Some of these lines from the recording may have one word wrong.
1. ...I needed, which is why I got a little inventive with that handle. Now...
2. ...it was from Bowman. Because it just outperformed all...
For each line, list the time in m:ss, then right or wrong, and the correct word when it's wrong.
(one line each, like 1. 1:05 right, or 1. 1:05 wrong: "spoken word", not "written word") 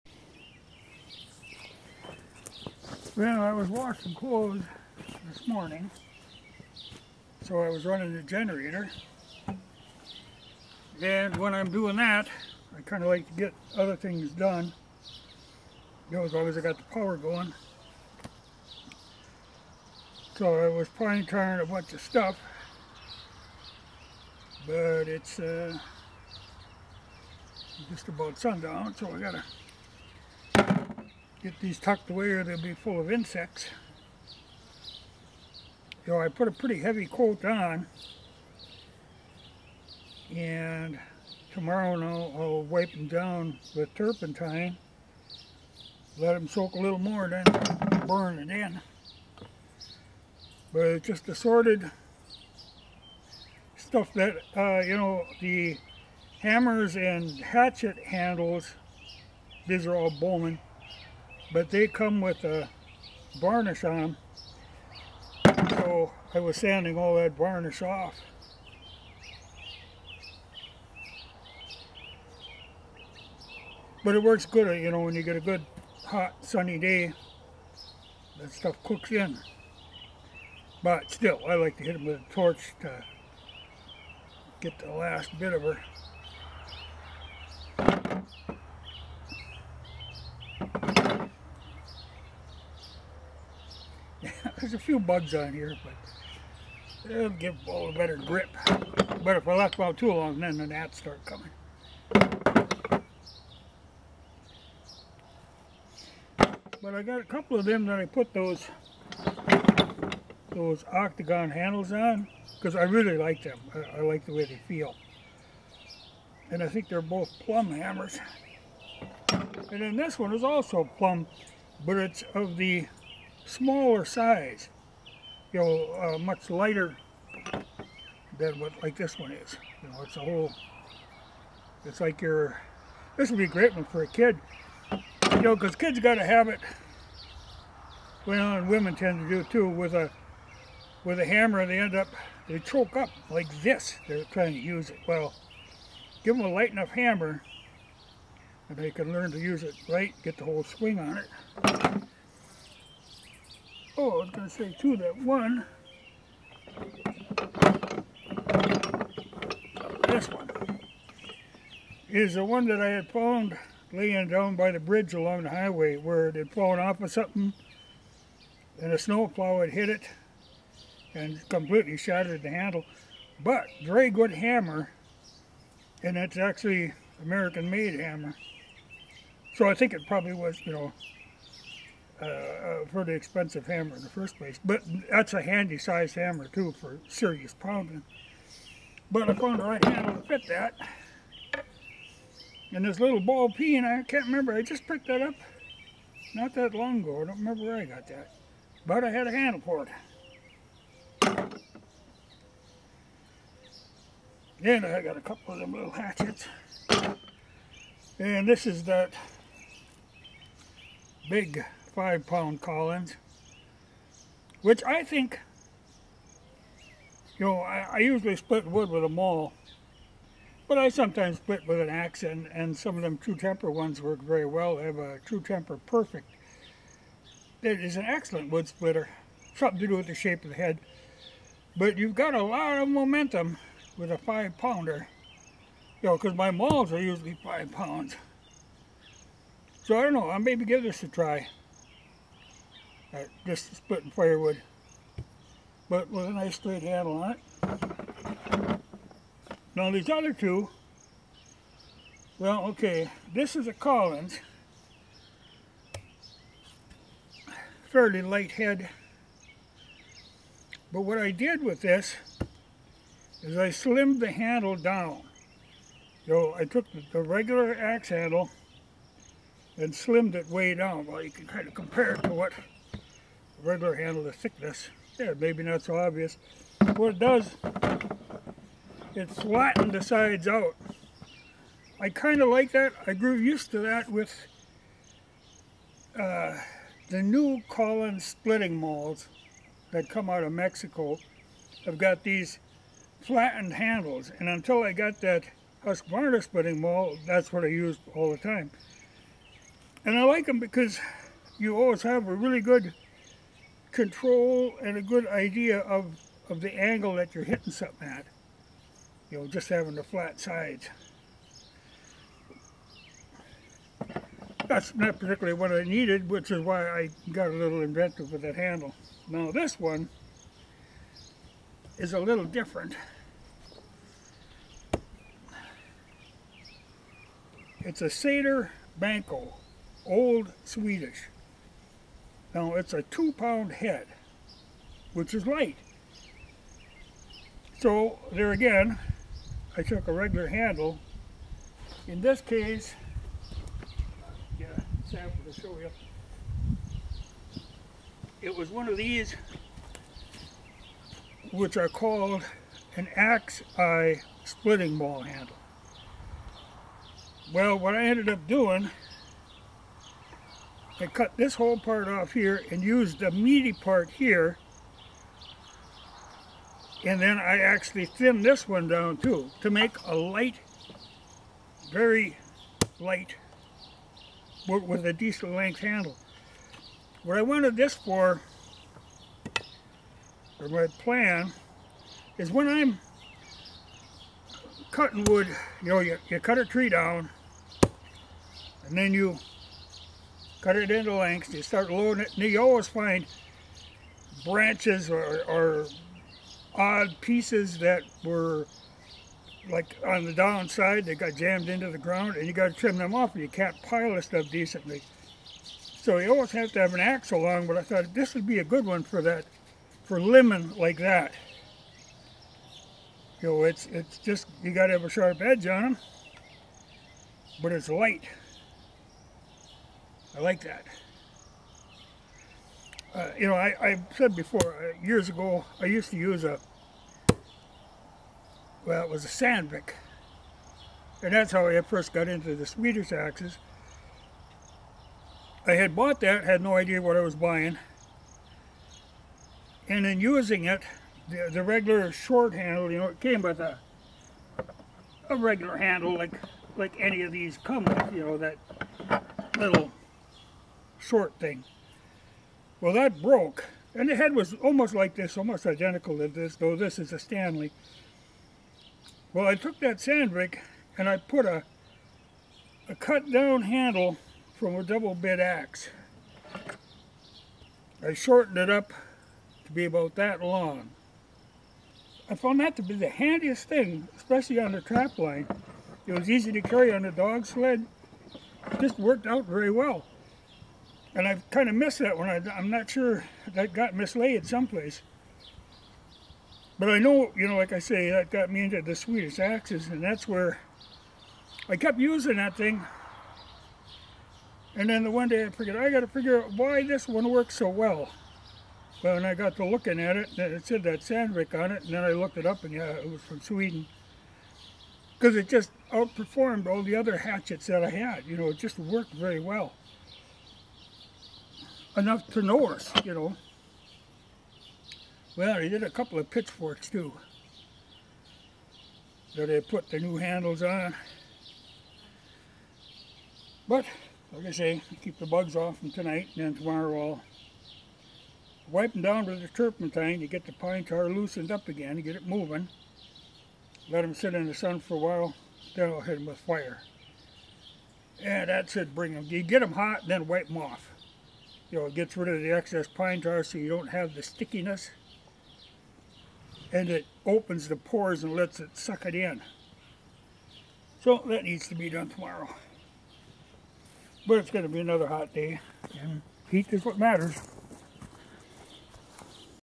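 1. 5:15 right
2. 8:22 wrong: "Sweden", not "Bowman".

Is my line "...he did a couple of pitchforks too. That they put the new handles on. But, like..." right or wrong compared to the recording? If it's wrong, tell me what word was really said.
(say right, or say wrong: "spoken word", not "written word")
right.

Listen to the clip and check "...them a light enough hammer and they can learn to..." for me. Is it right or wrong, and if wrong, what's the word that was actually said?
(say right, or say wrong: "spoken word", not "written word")
right.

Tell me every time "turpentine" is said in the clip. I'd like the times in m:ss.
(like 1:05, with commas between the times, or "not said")
0:43, 8:49.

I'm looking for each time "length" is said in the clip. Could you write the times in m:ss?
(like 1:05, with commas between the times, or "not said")
6:15, 6:31.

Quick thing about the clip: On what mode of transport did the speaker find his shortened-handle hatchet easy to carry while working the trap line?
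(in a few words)
dog sled.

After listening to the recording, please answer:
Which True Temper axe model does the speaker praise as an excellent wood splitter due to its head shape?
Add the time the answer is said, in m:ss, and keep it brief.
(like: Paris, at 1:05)
Perfect, at 3:45.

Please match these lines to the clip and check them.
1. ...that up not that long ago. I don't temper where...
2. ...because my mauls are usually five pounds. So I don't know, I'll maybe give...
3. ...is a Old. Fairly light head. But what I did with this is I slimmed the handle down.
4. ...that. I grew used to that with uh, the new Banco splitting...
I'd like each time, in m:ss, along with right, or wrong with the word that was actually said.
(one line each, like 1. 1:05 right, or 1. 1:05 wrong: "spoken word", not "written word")
1. 3:15 wrong: "remember", not "temper"
2. 3:56 right
3. 4:13 wrong: "Collins", not "Old"
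4. 4:42 wrong: "Collins", not "Banco".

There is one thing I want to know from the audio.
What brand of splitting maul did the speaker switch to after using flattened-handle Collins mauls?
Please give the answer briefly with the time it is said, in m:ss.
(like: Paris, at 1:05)
Husqvarna, at 4:55.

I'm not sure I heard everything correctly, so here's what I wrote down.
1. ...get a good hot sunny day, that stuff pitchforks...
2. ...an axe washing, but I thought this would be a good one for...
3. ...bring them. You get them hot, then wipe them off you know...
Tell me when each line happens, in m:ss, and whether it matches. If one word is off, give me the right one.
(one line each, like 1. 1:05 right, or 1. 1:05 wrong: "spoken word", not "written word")
1. 1:15 wrong: "cooks", not "pitchforks"
2. 6:46 wrong: "along", not "washing"
3. 8:58 right.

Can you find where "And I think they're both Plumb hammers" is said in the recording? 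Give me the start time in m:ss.
1:56.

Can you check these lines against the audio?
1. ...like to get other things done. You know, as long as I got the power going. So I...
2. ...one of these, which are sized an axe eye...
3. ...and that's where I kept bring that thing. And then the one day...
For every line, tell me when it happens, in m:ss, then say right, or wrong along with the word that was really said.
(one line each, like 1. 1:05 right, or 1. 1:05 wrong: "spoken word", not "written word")
1. 0:13 right
2. 5:48 wrong: "called", not "sized"
3. 8:09 wrong: "using", not "bring".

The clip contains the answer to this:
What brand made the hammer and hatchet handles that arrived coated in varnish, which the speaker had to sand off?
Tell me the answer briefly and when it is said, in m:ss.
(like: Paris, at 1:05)
Bowman, at 1:00.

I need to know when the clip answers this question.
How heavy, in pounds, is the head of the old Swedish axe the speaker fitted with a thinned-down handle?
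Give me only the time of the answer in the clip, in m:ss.
5:33.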